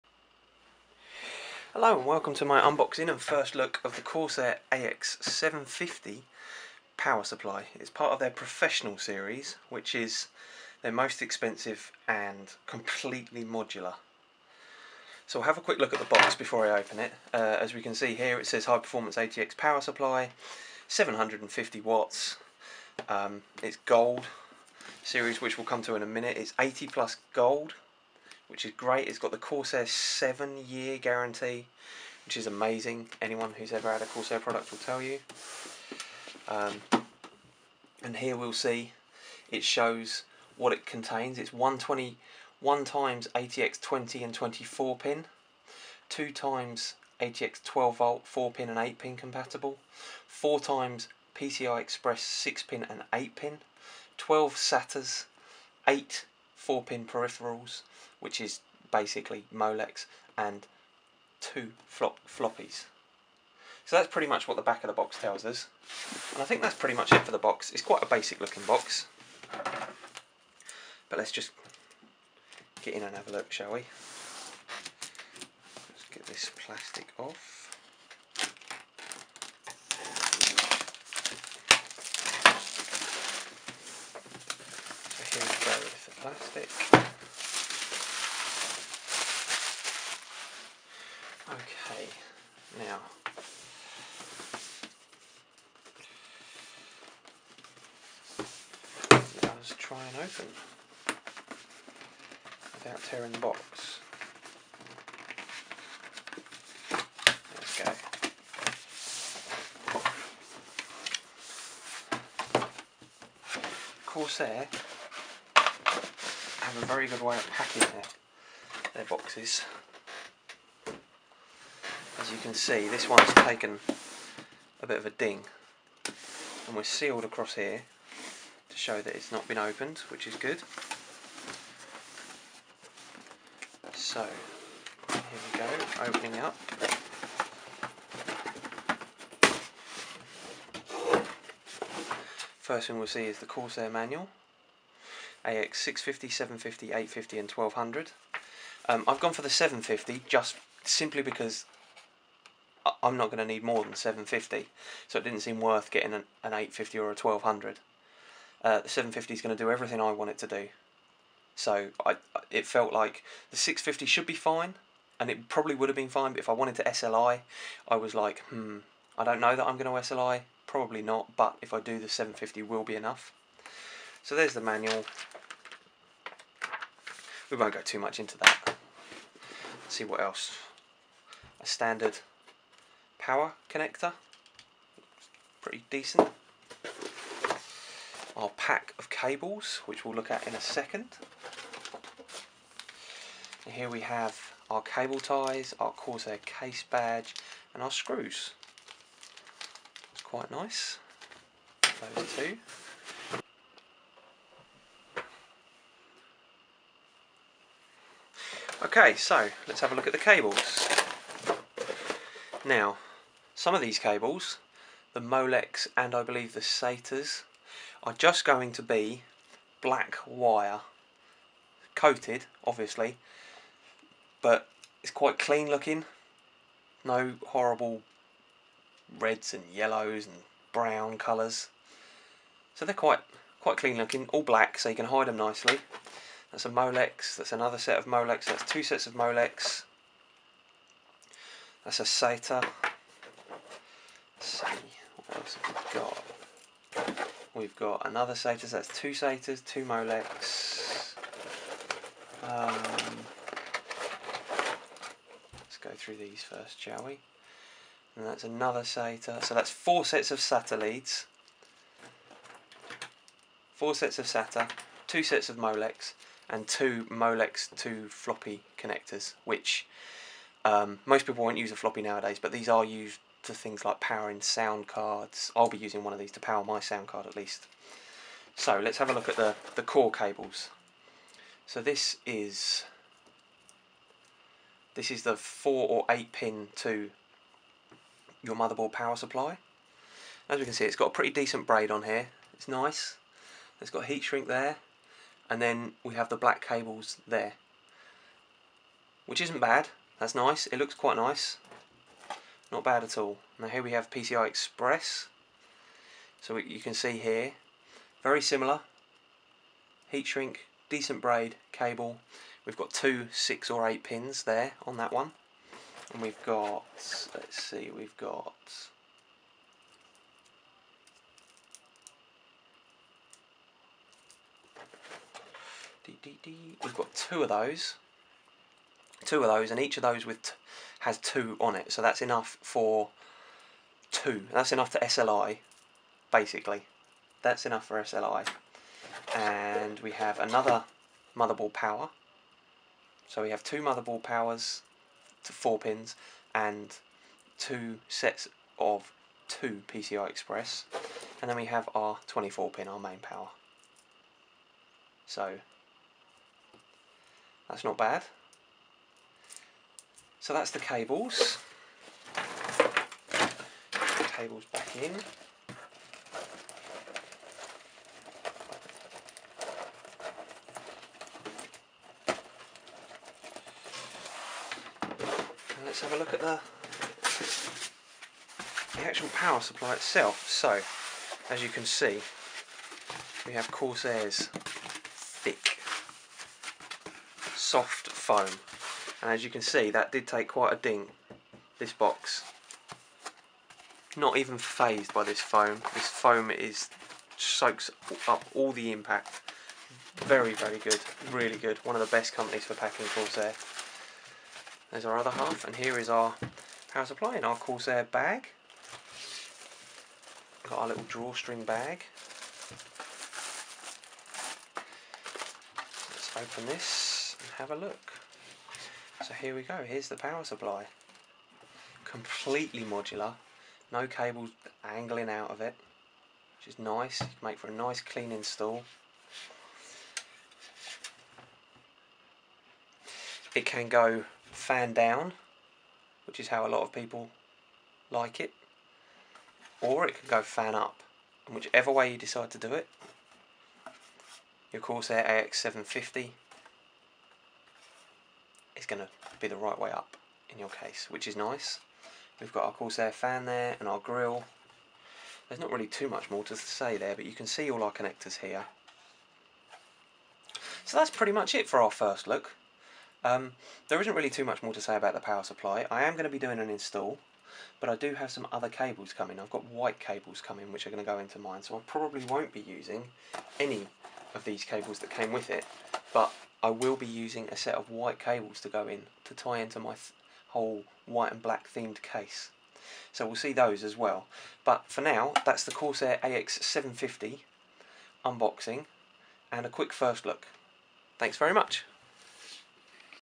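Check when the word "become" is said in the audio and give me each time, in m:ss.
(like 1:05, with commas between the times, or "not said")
not said.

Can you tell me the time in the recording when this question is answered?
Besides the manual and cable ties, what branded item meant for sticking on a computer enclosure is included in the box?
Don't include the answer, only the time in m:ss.
3:15.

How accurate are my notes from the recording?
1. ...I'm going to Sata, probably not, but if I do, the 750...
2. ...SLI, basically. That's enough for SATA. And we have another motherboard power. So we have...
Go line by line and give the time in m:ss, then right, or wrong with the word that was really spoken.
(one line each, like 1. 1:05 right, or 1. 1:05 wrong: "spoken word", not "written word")
1. 2:49 wrong: "SLI", not "Sata"
2. 5:34 wrong: "SLI", not "SATA".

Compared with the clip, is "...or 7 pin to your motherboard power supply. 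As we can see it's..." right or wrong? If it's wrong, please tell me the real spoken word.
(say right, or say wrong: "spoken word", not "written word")
wrong: "8", not "7".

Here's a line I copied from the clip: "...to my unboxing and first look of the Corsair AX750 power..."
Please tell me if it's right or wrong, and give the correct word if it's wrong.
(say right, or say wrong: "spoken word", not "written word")
right.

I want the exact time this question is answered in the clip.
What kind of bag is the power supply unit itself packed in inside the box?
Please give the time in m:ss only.
6:51.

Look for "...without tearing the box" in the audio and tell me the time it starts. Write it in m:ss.
1:42.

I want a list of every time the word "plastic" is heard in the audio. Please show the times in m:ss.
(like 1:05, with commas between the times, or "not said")
1:16, 1:26.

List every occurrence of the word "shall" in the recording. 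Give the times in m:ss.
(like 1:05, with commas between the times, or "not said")
1:13, 4:16.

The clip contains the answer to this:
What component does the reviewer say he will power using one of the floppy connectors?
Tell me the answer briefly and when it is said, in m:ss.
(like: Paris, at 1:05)
Sound card, at 4:36.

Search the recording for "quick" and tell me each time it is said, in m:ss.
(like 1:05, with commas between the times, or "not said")
0:15, 8:09.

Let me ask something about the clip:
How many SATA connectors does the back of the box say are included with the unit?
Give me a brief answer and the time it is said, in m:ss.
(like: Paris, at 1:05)
12, at 0:54.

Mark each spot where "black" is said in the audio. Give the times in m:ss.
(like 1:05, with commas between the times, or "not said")
3:39, 3:54, 4:56, 8:01.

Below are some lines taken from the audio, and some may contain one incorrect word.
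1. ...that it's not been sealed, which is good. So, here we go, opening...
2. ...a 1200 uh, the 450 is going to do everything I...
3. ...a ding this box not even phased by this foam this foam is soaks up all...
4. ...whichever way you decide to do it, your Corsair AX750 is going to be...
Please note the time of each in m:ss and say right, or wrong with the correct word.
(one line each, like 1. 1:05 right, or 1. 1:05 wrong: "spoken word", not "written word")
1. 2:09 wrong: "opened", not "sealed"
2. 2:37 wrong: "750", not "450"
3. 6:30 right
4. 7:21 right.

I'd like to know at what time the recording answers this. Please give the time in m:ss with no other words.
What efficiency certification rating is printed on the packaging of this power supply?
0:26.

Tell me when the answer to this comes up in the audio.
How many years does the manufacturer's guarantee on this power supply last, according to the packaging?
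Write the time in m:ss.
0:29.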